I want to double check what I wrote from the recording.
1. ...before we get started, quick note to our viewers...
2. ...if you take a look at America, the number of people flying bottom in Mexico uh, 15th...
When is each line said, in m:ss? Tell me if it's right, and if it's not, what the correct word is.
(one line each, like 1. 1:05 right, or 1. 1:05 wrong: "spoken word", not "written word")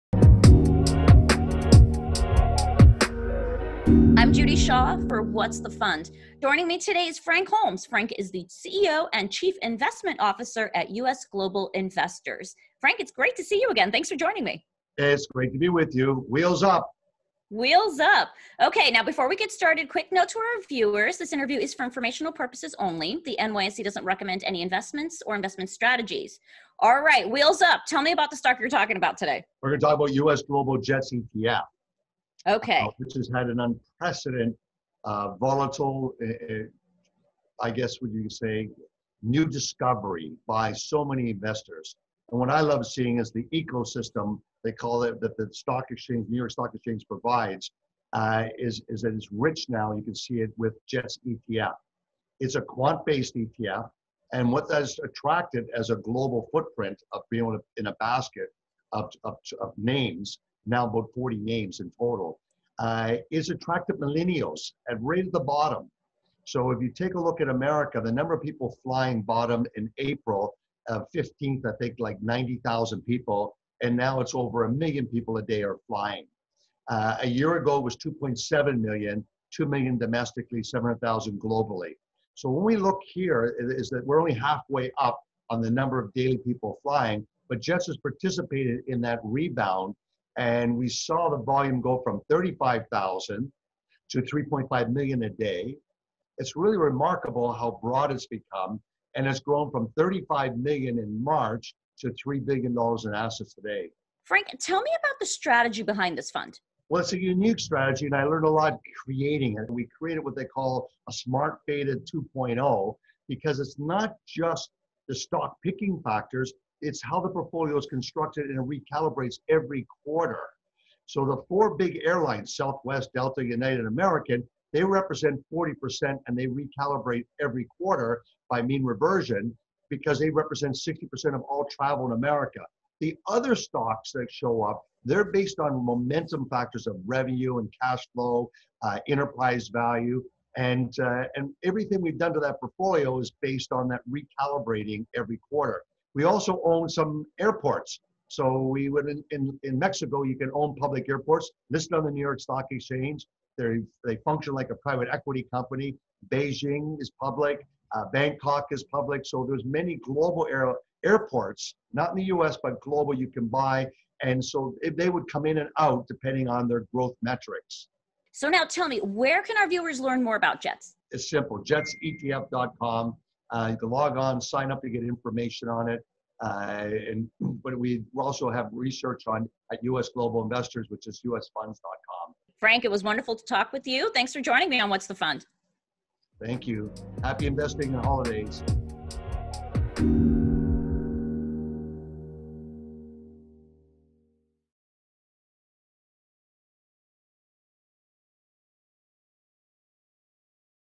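1. 0:19 right
2. 1:06 wrong: "April", not "Mexico".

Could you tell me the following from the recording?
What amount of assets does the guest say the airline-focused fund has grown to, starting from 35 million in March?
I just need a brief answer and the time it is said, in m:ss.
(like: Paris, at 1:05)
$3 billion, at 1:42.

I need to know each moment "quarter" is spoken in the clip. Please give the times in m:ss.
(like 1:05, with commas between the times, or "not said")
2:00, 2:07, 2:25.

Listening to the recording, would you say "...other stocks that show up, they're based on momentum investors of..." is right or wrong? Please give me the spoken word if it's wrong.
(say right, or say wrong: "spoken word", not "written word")
wrong: "factors", not "investors".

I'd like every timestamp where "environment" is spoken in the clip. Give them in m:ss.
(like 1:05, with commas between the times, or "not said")
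not said.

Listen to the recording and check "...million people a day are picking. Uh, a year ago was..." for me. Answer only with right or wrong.
wrong.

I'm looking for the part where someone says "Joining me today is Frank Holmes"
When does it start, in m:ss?
0:06.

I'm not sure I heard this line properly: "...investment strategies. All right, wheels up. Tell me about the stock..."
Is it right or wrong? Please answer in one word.
right.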